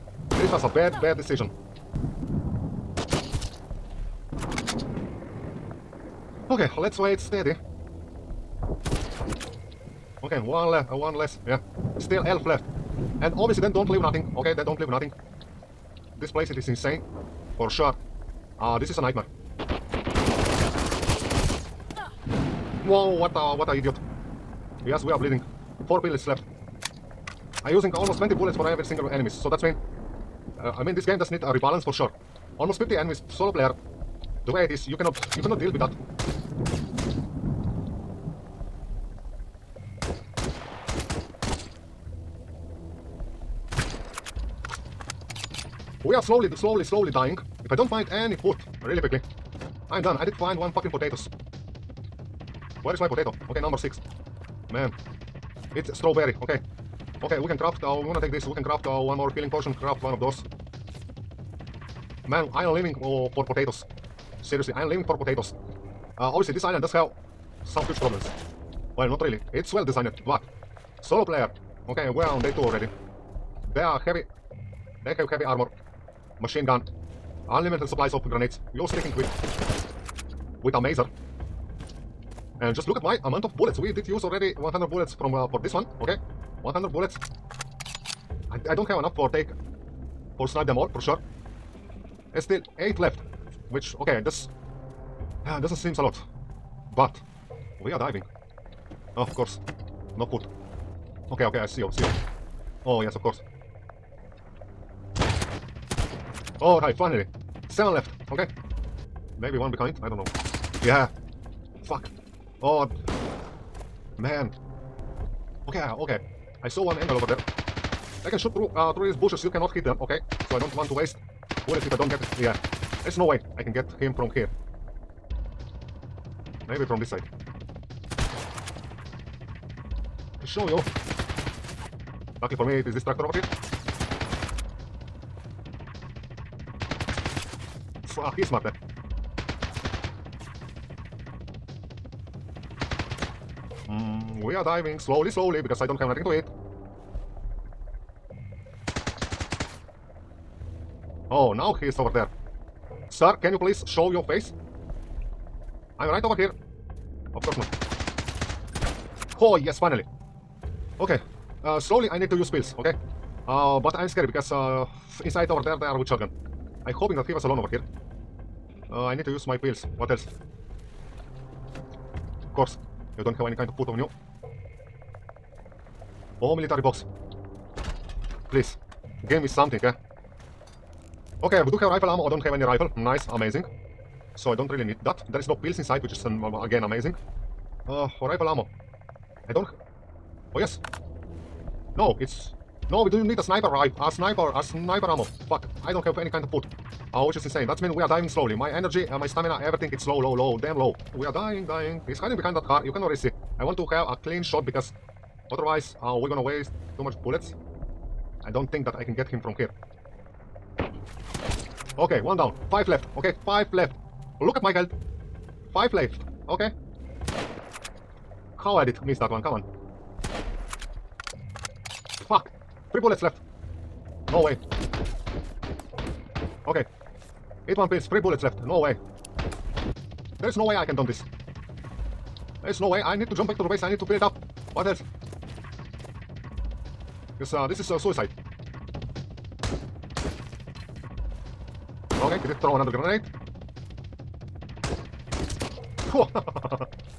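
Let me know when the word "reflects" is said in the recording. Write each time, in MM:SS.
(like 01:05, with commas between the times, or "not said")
not said.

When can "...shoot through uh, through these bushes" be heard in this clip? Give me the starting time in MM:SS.
01:58.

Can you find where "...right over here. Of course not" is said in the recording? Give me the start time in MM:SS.
02:36.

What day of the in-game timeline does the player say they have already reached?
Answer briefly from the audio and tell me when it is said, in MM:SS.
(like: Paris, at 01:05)
day 2, at 01:12.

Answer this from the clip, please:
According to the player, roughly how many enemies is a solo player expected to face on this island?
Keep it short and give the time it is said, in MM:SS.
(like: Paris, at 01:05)
50, at 00:32.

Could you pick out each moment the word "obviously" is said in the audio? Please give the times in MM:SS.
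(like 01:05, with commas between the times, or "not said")
00:13, 01:06.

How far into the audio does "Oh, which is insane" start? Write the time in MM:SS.
03:17.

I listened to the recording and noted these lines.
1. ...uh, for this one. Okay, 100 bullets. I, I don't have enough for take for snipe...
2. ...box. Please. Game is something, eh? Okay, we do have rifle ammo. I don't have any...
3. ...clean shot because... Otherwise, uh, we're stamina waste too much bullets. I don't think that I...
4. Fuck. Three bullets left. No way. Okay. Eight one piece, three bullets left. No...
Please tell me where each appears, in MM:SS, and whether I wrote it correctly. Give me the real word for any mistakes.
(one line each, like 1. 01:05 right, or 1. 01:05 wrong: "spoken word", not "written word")
1. 01:25 right
2. 02:56 right
3. 03:24 wrong: "gonna", not "stamina"
4. 03:42 right.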